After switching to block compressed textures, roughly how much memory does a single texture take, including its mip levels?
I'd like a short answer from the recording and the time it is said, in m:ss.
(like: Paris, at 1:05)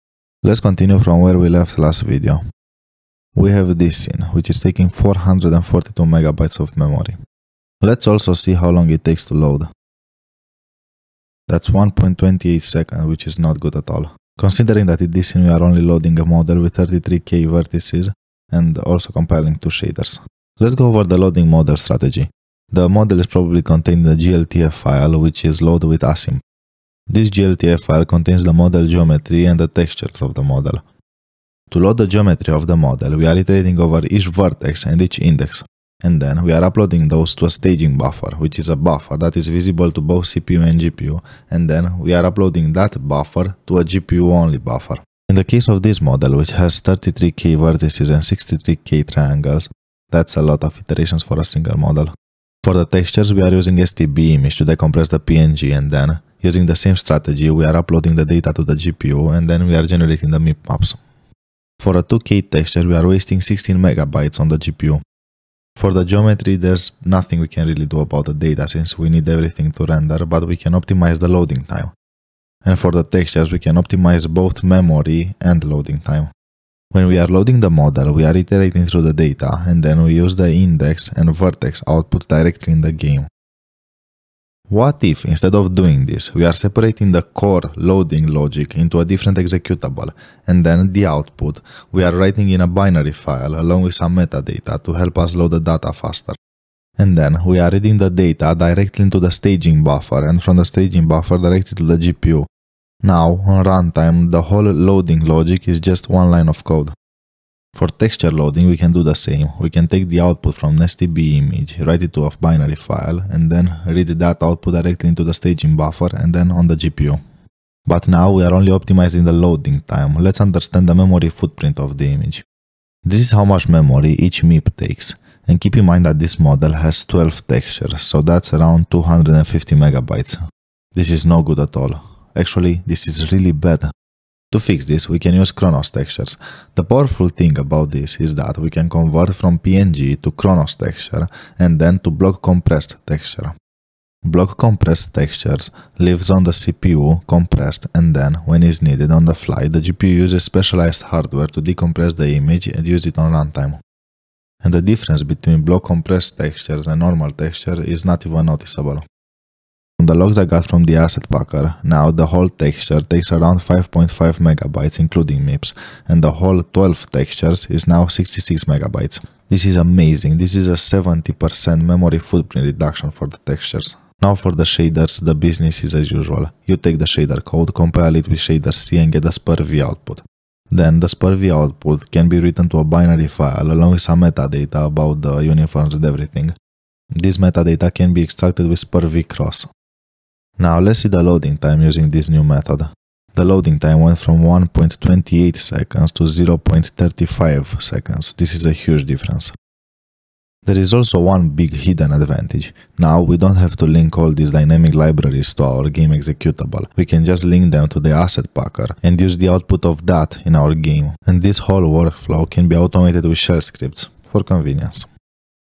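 5.5 megabytes, at 2:43.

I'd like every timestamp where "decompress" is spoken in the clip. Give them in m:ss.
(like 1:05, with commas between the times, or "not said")
0:54, 2:31.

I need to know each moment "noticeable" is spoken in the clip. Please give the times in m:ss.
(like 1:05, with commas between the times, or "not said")
2:38.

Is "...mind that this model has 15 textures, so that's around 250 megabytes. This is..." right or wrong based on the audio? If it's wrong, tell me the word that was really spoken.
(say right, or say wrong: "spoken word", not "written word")
wrong: "12", not "15".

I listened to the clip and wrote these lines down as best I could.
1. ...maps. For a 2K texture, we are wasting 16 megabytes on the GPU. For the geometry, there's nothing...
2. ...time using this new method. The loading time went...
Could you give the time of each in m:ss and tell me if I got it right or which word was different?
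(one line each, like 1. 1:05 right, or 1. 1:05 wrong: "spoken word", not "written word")
1. 1:00 right
2. 3:11 right.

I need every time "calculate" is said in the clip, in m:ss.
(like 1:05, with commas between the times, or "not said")
not said.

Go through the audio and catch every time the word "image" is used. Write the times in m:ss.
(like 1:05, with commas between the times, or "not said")
0:54, 1:51, 2:02, 2:32.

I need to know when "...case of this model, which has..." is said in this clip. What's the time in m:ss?
0:45.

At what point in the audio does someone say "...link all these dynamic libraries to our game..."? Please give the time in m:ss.
3:23.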